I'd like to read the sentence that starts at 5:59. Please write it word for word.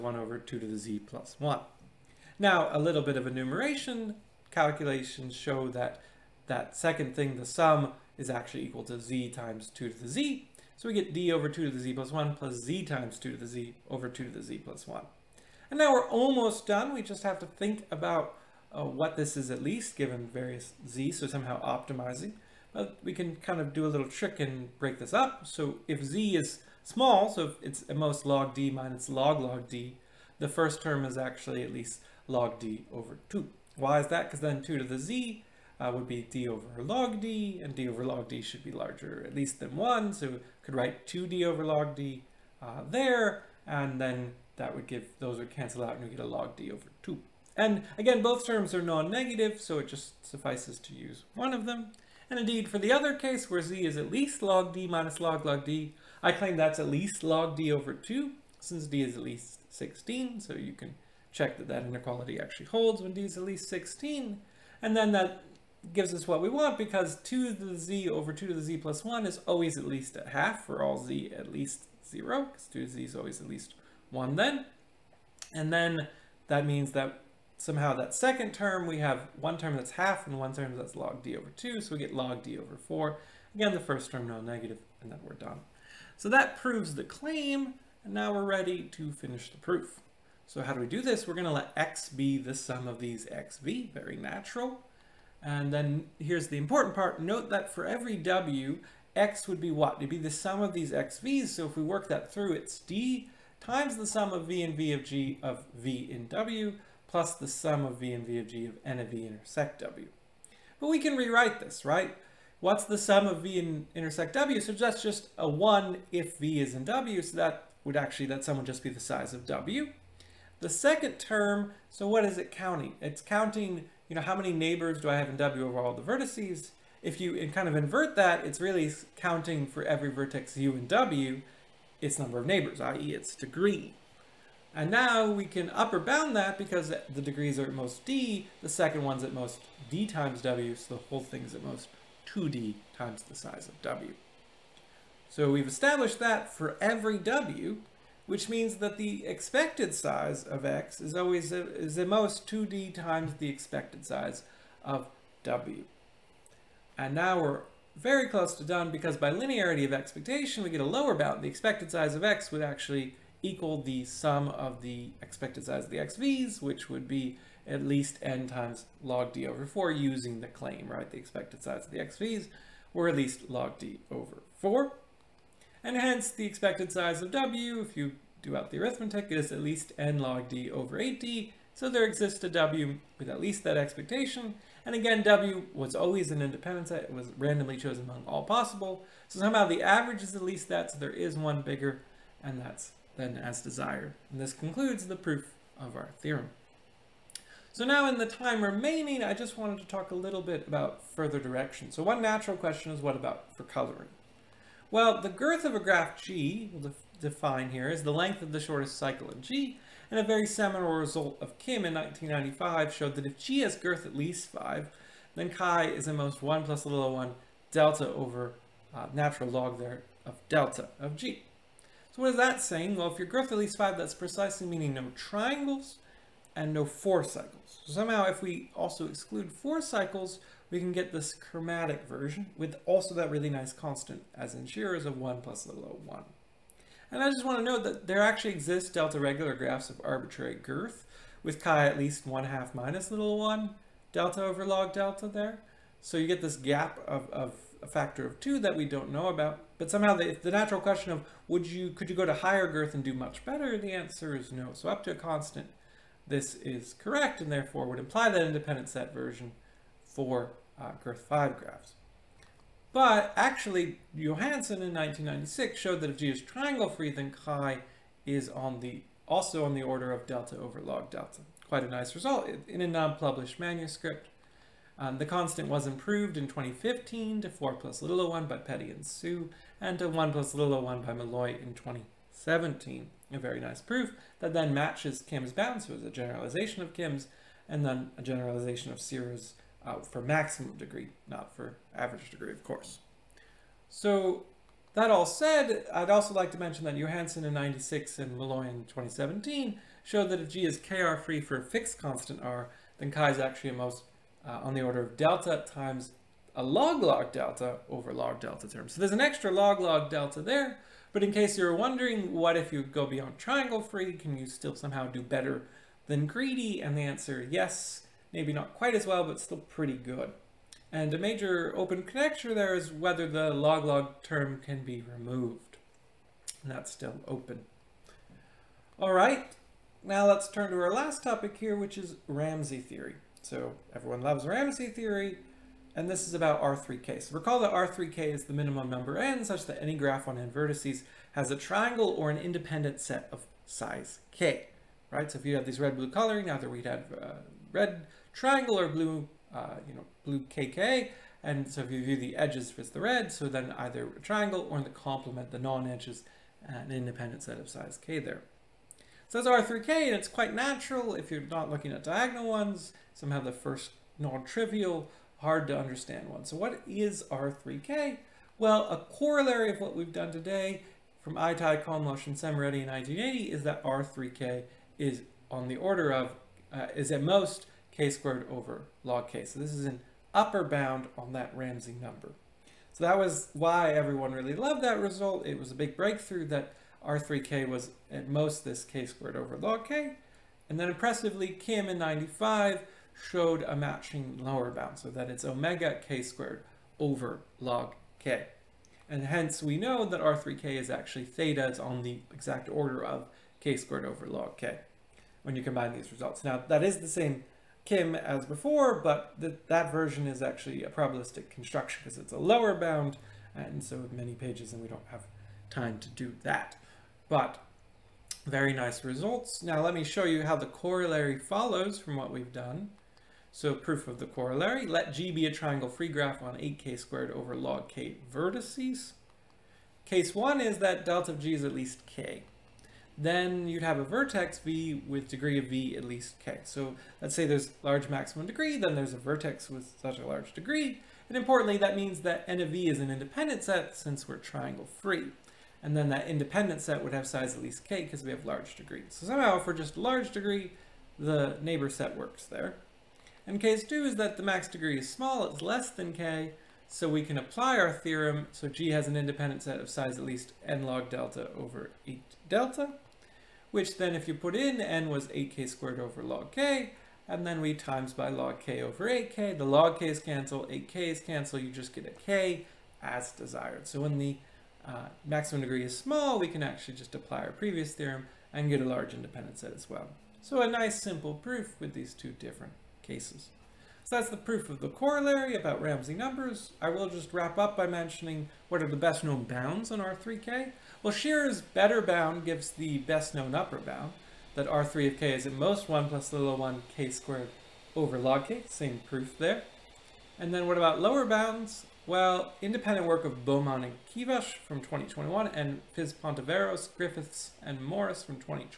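So that's R3K, and it's quite natural if you're not looking at diagonal ones.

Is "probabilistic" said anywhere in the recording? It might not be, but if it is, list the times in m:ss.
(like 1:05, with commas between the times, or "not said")
6:50.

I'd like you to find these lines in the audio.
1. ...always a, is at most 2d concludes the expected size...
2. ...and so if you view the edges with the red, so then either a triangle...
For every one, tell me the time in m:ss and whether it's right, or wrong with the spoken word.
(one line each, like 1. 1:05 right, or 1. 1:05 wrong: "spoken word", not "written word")
1. 2:31 wrong: "times", not "concludes"
2. 5:51 right.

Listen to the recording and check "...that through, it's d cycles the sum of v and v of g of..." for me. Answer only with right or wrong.
wrong.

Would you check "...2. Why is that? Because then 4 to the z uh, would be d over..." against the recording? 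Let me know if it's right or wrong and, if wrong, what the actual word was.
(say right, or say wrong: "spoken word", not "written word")
wrong: "2", not "4".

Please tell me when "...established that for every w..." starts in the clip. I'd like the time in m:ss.
2:25.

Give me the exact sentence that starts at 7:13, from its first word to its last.
Then you'd have a vertex V with degree of V at least k.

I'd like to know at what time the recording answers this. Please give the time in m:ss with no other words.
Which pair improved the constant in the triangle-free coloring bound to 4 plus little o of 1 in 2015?
4:38.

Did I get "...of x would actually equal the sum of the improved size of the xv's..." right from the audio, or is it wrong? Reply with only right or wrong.
wrong.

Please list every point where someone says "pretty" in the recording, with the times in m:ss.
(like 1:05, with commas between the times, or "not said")
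5:19.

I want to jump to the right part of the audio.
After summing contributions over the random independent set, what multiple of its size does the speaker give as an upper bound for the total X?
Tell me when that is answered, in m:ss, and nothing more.
2:22.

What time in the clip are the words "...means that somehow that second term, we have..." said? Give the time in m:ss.
1:16.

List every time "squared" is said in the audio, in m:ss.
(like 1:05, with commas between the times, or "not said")
6:18, 6:29, 6:36, 6:43, 7:06, 7:45, 8:17.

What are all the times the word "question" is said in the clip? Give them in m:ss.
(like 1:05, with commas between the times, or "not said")
3:22, 4:10.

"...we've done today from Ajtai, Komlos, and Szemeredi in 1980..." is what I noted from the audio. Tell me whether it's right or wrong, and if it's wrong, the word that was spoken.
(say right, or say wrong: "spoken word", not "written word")
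right.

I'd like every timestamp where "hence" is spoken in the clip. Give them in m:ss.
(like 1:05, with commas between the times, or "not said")
2:55, 6:39.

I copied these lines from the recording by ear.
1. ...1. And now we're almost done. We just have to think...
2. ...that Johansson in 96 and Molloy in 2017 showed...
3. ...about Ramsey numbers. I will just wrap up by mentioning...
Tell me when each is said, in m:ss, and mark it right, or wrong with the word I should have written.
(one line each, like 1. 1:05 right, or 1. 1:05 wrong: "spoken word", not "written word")
1. 0:14 right
2. 4:56 right
3. 8:05 right.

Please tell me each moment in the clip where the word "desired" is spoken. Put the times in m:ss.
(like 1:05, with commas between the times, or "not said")
3:13, 7:53.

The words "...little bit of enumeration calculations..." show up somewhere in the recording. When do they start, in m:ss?
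0:02.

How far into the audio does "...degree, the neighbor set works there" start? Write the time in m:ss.
7:30.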